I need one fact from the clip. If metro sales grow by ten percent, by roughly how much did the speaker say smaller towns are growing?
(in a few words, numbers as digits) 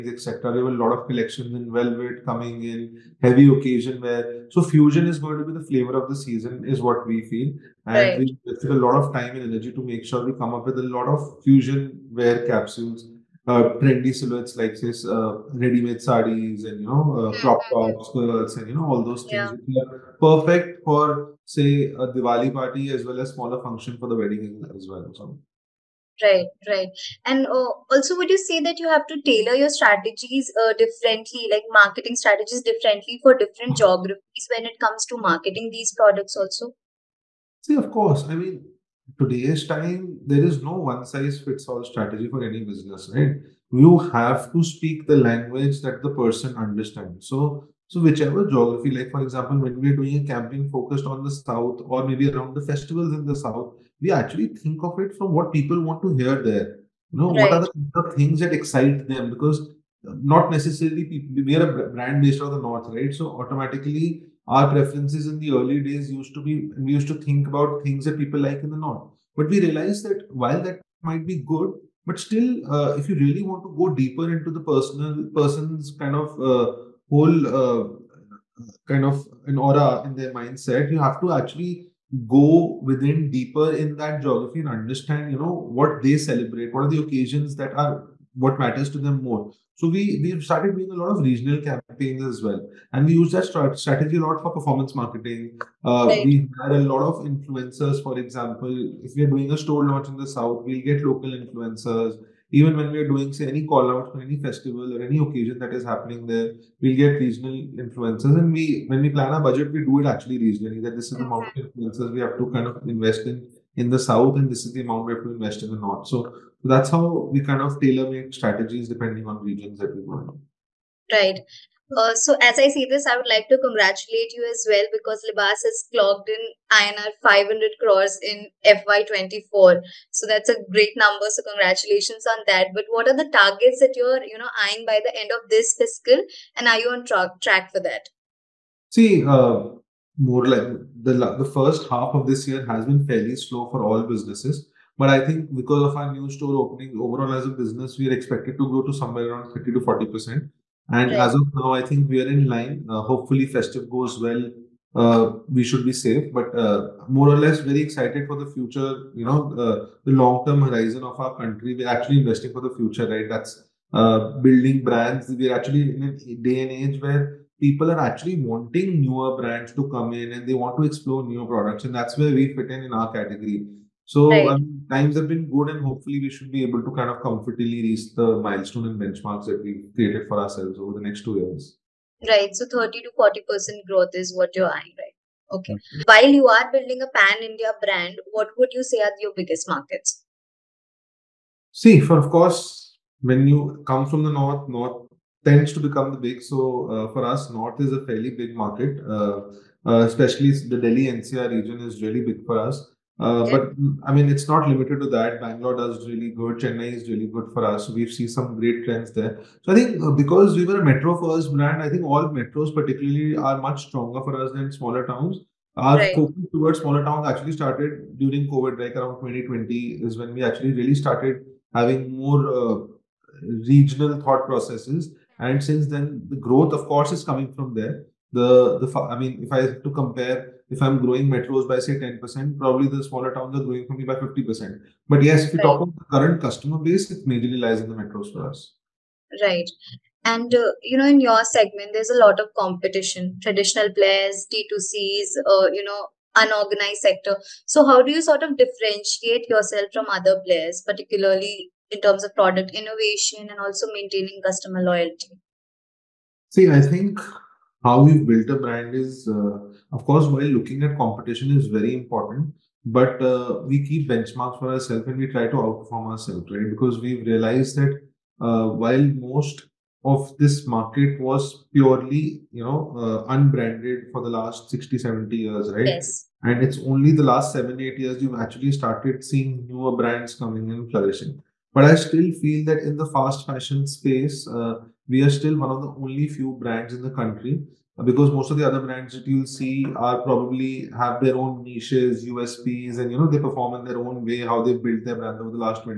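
50%.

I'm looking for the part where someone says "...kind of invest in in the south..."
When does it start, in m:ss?
1:52.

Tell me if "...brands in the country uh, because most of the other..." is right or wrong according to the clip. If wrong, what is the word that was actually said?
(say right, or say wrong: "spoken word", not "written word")
right.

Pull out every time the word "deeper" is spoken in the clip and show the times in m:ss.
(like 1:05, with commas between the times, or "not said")
1:13, 1:23.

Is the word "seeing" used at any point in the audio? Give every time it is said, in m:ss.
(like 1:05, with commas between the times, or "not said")
4:39.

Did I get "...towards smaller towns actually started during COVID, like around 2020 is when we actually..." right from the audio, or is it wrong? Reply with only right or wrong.
right.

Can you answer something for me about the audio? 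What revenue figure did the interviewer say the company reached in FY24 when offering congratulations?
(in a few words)
INR 500 crores.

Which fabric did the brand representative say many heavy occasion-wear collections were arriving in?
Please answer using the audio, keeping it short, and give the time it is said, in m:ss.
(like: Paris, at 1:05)
velvet, at 0:01.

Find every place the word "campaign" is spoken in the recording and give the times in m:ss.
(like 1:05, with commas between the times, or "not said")
0:50, 1:31.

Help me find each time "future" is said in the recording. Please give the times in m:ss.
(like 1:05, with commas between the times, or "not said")
2:38, 2:42.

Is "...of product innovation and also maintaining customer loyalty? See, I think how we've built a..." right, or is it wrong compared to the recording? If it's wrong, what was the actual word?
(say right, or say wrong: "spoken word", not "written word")
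right.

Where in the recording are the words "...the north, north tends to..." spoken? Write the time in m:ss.
3:14.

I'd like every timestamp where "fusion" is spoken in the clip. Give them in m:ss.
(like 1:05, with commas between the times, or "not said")
0:04, 0:11.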